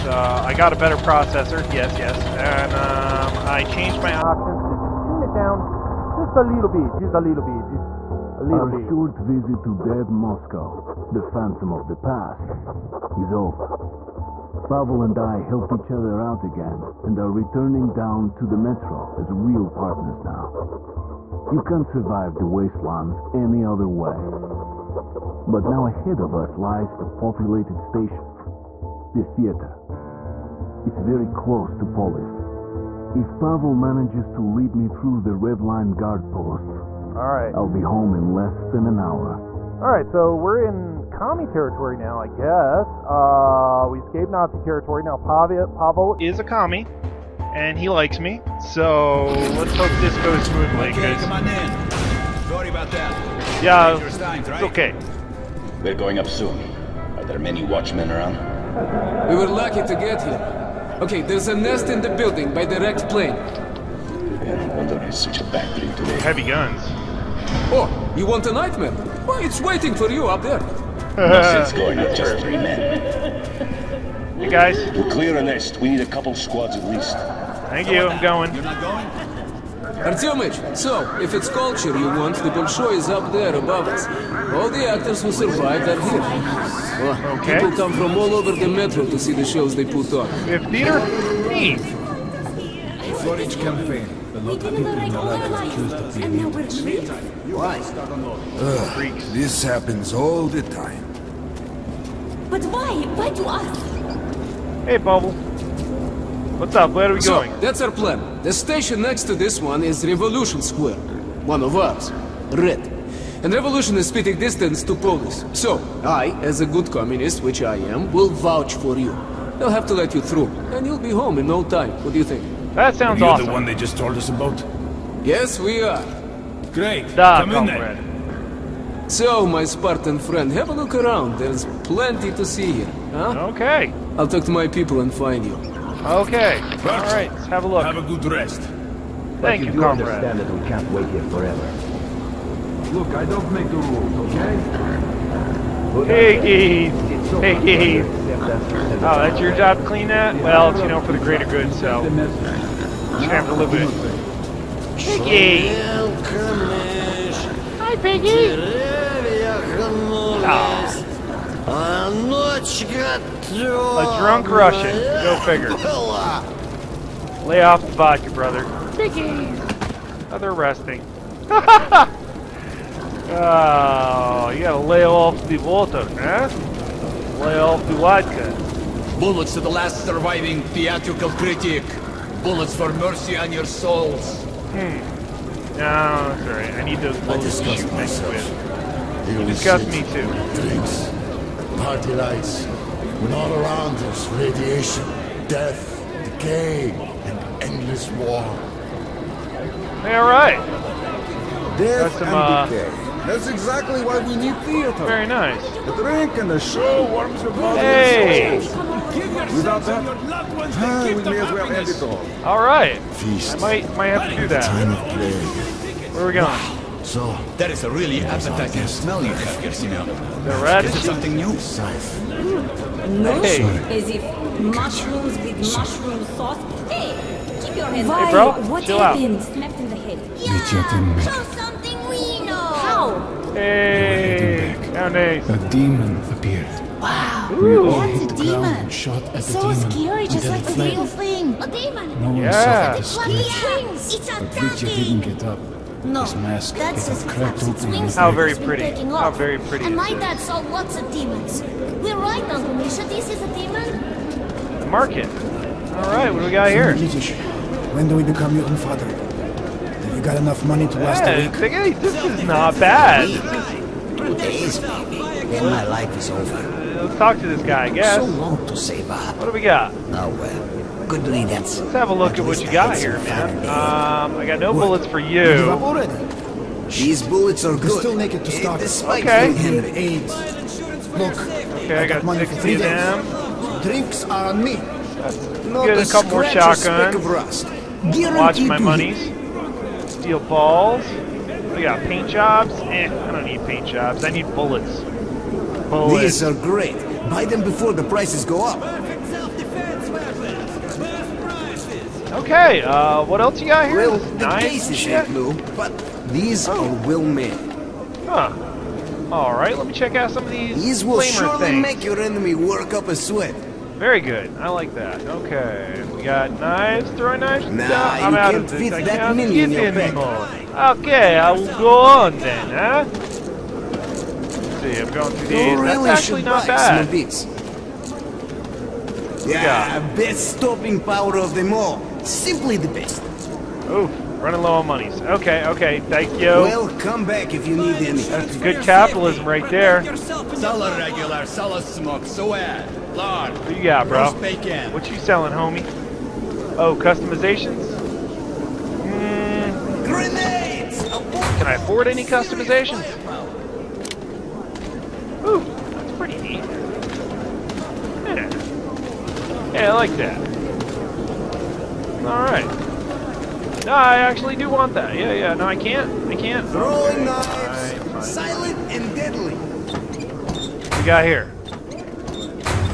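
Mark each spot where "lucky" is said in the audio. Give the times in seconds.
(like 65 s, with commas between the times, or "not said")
59 s.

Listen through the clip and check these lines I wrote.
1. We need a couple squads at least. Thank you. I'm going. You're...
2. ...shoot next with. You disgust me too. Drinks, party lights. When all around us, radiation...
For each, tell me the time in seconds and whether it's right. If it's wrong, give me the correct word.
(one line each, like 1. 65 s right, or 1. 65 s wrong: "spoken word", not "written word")
1. 75 s right
2. 187 s right.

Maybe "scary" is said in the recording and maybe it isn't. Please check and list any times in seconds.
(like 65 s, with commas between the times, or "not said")
239 s.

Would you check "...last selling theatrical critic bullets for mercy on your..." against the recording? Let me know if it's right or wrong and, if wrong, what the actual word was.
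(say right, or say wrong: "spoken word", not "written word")
wrong: "surviving", not "selling".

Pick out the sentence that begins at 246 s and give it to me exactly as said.
No, his mask that's his cracked open.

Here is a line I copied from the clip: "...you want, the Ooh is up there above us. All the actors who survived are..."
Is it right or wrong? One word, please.
wrong.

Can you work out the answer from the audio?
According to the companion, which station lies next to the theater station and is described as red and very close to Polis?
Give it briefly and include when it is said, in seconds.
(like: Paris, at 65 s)
Revolution Square, at 110 s.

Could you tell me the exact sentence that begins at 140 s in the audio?
understand that we can't wait here forever.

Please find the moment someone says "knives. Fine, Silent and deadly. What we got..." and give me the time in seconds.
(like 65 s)
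367 s.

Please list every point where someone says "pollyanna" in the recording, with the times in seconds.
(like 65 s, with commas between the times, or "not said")
not said.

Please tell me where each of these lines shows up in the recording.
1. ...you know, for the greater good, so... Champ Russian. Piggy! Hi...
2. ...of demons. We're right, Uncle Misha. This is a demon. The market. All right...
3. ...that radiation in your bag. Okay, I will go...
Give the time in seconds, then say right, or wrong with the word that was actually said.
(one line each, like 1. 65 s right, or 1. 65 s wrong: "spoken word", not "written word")
1. 150 s wrong: "Olympic", not "Russian"
2. 250 s right
3. 319 s wrong: "minion", not "radiation".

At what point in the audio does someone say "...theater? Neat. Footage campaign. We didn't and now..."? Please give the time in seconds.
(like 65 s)
90 s.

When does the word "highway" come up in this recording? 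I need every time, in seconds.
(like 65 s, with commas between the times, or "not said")
not said.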